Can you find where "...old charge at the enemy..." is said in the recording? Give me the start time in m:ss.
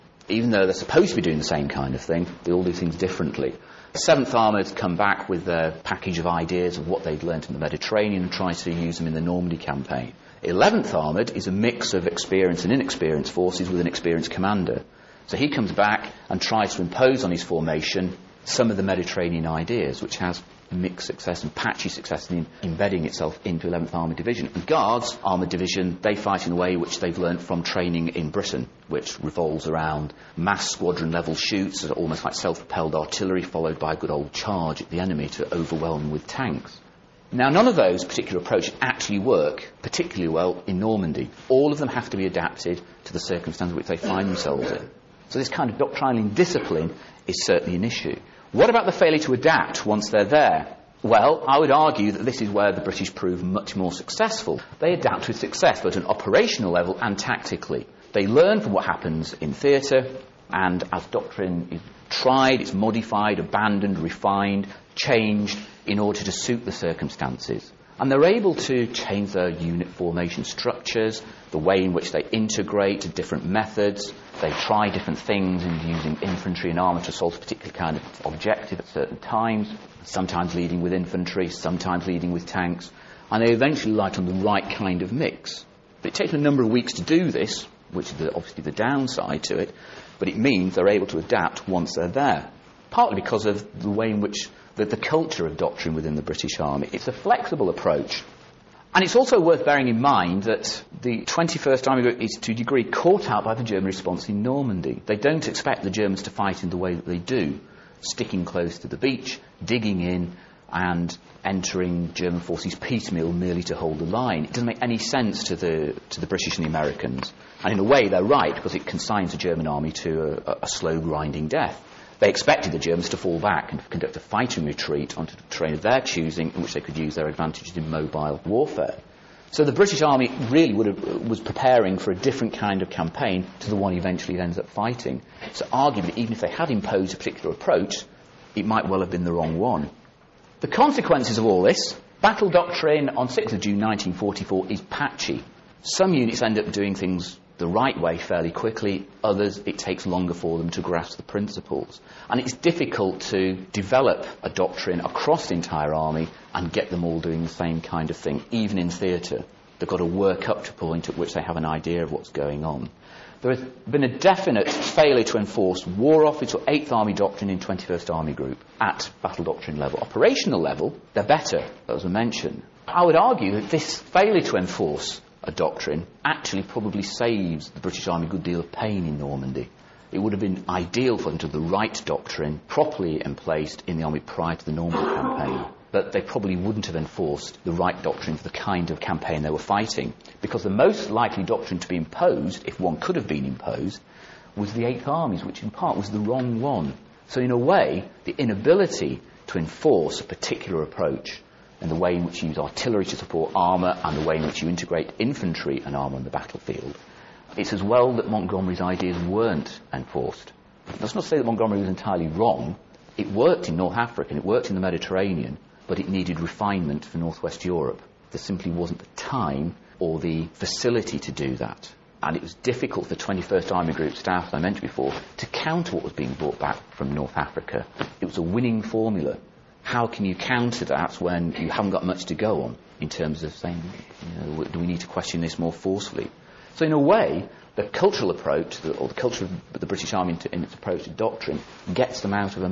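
0:34.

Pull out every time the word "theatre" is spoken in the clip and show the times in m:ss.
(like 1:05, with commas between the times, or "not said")
0:59, 2:38.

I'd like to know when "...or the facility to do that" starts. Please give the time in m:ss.
3:39.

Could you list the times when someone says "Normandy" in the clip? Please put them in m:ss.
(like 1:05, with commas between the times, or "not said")
0:09, 0:40, 1:44, 2:59, 3:04.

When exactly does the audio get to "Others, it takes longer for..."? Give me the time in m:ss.
2:29.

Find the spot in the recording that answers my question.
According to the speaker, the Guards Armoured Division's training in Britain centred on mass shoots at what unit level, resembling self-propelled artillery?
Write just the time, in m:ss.
0:30.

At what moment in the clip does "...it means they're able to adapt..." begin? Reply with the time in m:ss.
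1:30.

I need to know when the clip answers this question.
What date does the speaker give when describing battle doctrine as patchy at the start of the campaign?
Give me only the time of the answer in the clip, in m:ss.
2:23.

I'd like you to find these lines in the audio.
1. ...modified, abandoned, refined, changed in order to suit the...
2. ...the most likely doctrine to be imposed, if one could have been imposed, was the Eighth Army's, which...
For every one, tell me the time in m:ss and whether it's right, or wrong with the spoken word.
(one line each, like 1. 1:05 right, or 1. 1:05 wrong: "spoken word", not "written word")
1. 1:02 right
2. 3:10 right.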